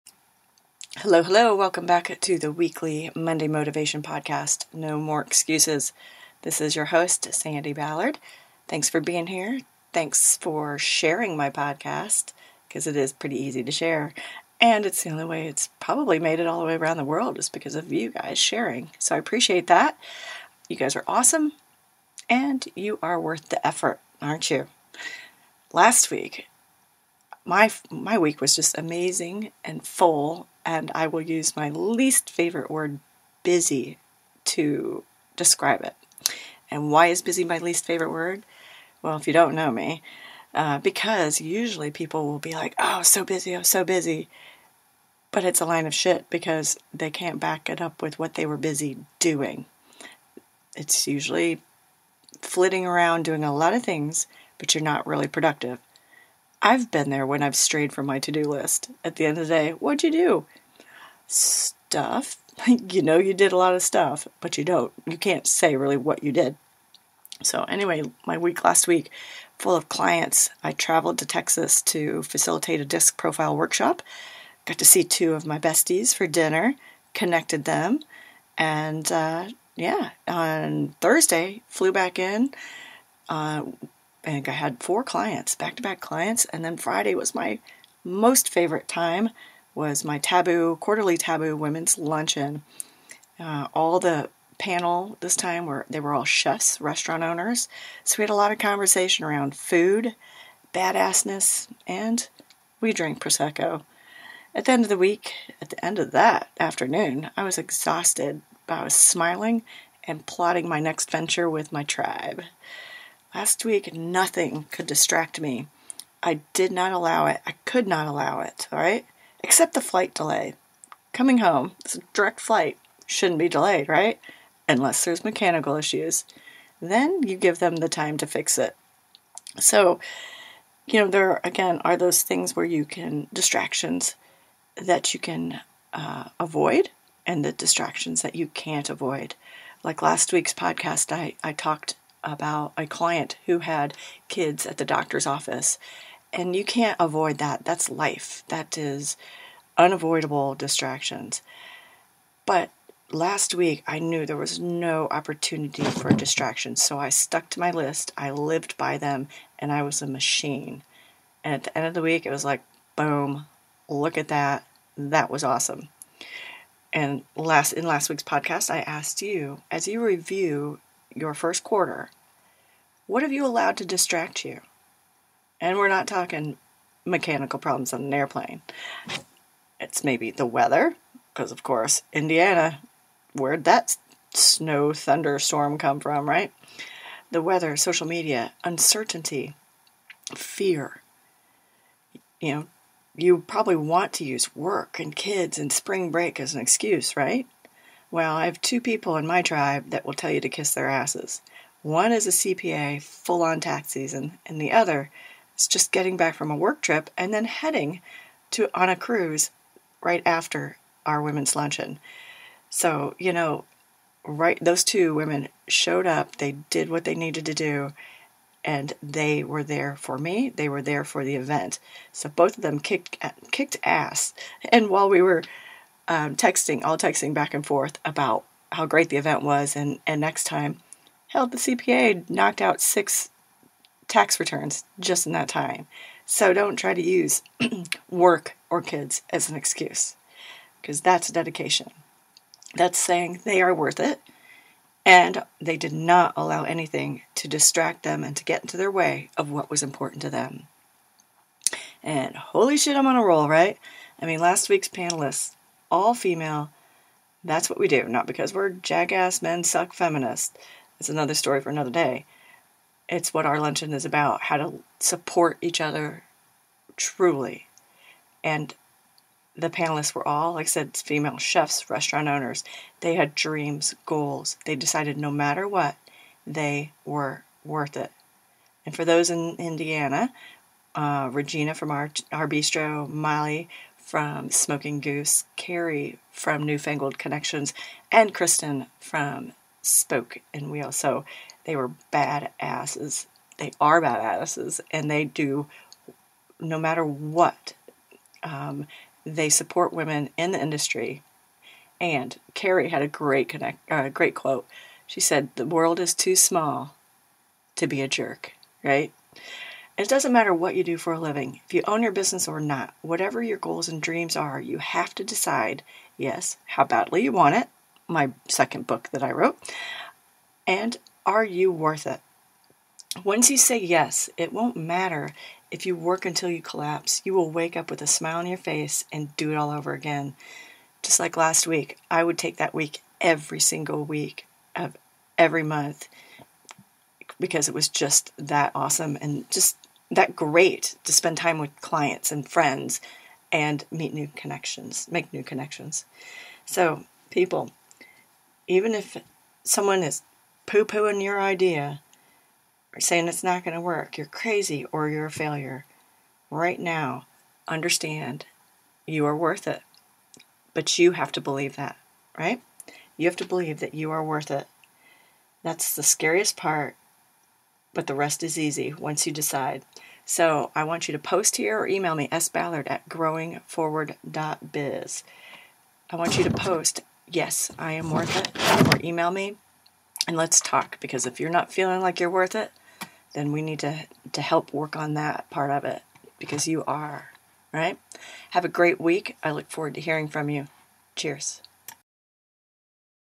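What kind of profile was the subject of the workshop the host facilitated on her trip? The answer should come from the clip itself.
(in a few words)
DISC.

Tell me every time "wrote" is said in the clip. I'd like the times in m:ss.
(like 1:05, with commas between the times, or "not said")
5:19.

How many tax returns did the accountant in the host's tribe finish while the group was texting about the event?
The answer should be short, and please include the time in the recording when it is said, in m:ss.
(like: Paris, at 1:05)
6, at 3:52.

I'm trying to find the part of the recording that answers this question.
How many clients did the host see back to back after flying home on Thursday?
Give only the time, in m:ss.
1:24.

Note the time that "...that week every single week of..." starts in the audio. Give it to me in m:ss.
5:32.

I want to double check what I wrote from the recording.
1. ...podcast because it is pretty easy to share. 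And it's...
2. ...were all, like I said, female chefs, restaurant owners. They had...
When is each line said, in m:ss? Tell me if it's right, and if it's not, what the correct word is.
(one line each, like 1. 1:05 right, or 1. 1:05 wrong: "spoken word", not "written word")
1. 0:11 right
2. 4:30 right.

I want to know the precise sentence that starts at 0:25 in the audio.
Last week, my my week was just amazing and full and I will use my least favorite word, busy, to describe it.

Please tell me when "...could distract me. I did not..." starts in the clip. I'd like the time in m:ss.
1:54.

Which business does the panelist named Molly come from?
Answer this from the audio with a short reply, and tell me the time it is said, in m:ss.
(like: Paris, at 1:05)
Smoking Goose, at 4:44.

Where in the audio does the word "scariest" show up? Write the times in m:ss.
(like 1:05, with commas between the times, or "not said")
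6:06.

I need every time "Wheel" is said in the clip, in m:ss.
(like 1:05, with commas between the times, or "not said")
4:50.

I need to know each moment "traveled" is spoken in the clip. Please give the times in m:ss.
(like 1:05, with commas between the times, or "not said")
1:10.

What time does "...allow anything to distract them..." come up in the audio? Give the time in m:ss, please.
4:06.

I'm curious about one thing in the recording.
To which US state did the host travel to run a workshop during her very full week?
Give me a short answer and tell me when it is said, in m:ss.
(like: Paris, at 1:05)
Texas, at 1:11.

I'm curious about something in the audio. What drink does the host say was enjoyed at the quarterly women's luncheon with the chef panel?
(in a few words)
Prosecco.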